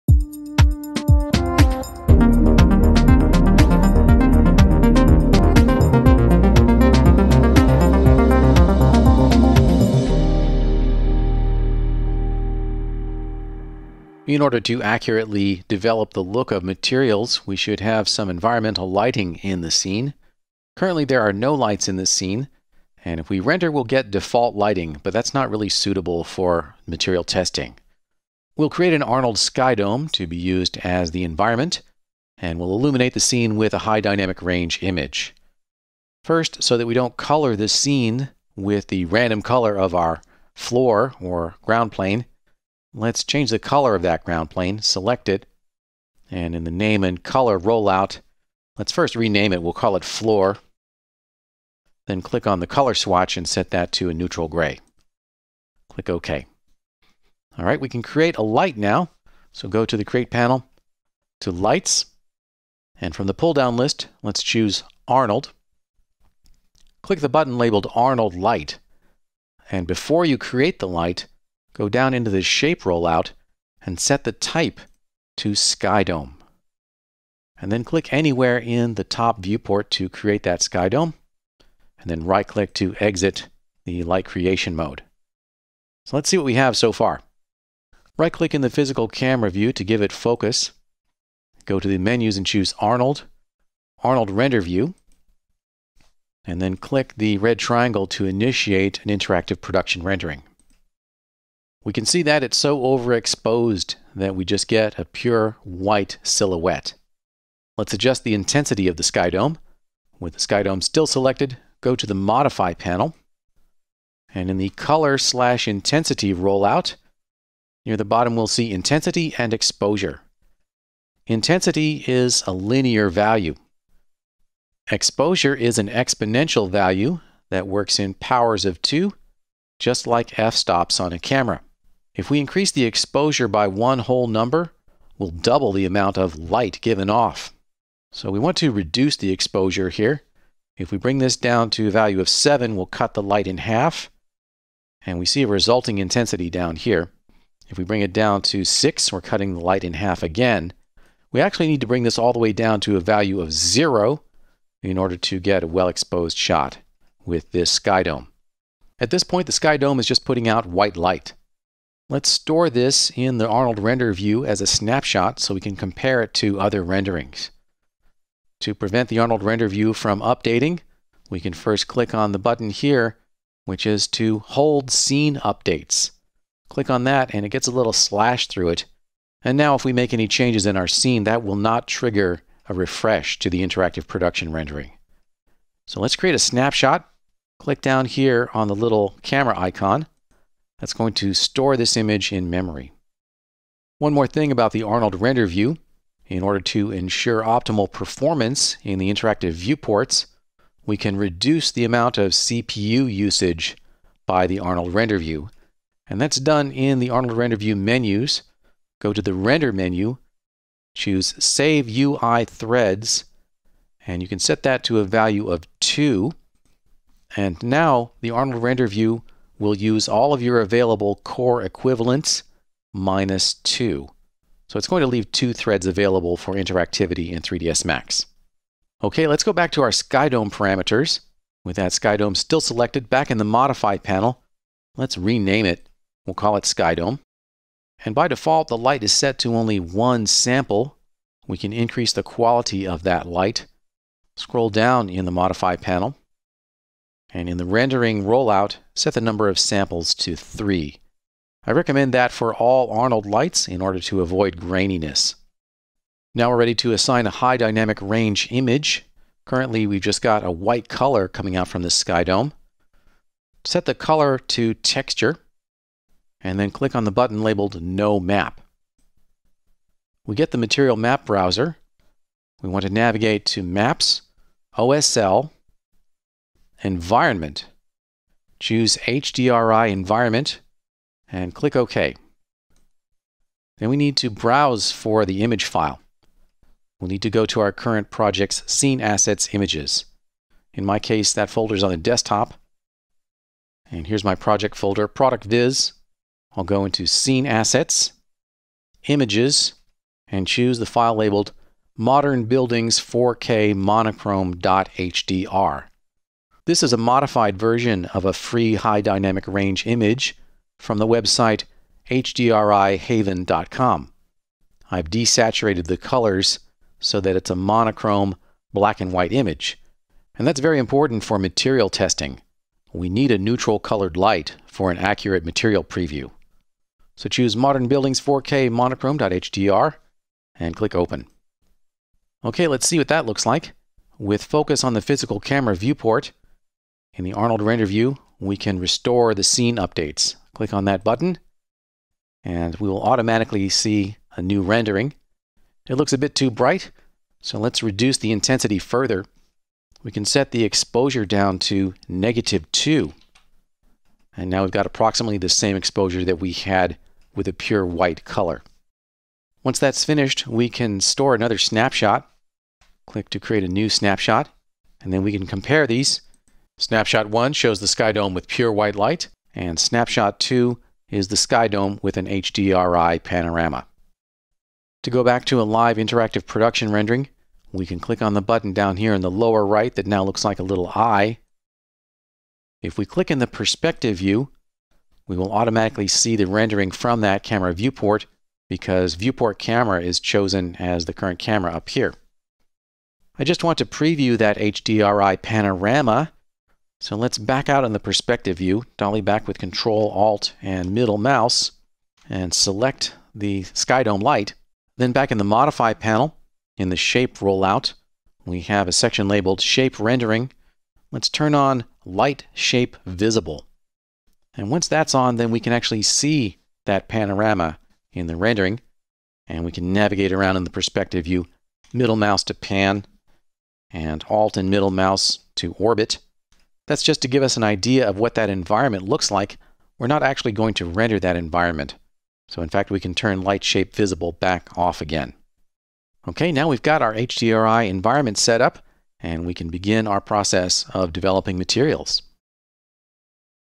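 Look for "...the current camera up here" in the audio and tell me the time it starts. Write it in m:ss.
6:31.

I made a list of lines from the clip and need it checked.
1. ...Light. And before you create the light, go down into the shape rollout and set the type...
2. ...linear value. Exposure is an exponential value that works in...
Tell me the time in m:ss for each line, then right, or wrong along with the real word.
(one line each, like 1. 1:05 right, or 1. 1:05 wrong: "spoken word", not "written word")
1. 1:08 right
2. 2:02 right.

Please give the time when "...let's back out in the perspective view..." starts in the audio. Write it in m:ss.
6:37.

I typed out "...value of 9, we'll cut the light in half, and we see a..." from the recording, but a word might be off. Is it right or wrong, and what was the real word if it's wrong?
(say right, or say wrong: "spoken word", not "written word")
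wrong: "7", not "9".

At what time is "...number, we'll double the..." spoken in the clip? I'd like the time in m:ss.
2:14.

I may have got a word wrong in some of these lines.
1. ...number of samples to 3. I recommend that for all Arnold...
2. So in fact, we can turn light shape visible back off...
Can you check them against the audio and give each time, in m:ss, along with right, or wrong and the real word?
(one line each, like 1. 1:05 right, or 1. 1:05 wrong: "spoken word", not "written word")
1. 4:09 right
2. 7:12 right.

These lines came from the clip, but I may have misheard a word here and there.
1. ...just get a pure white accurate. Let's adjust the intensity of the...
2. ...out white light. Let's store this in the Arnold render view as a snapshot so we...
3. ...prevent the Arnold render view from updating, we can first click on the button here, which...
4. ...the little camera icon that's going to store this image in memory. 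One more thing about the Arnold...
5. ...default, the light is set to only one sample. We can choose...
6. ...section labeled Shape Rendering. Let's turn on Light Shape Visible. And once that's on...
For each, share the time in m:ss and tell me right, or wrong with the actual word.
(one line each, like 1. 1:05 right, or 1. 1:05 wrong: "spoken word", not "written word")
1. 1:44 wrong: "silhouette", not "accurate"
2. 2:40 right
3. 2:48 right
4. 3:08 right
5. 3:58 wrong: "increase", not "choose"
6. 6:48 right.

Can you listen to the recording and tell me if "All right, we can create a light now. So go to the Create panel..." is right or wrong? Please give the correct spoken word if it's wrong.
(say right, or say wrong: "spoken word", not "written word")
right.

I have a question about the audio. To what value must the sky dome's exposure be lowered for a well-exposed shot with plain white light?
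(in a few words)
0.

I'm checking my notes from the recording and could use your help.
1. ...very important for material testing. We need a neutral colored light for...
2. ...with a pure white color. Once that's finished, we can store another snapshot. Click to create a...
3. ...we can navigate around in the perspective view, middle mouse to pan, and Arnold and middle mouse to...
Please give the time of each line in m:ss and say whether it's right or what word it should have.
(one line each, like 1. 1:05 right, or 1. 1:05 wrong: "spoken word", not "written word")
1. 5:20 right
2. 5:57 right
3. 6:59 wrong: "Alt", not "Arnold".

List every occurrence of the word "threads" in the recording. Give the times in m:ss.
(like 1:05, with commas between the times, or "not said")
3:32, 3:45.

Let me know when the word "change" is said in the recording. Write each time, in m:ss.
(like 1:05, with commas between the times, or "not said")
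0:43, 3:00.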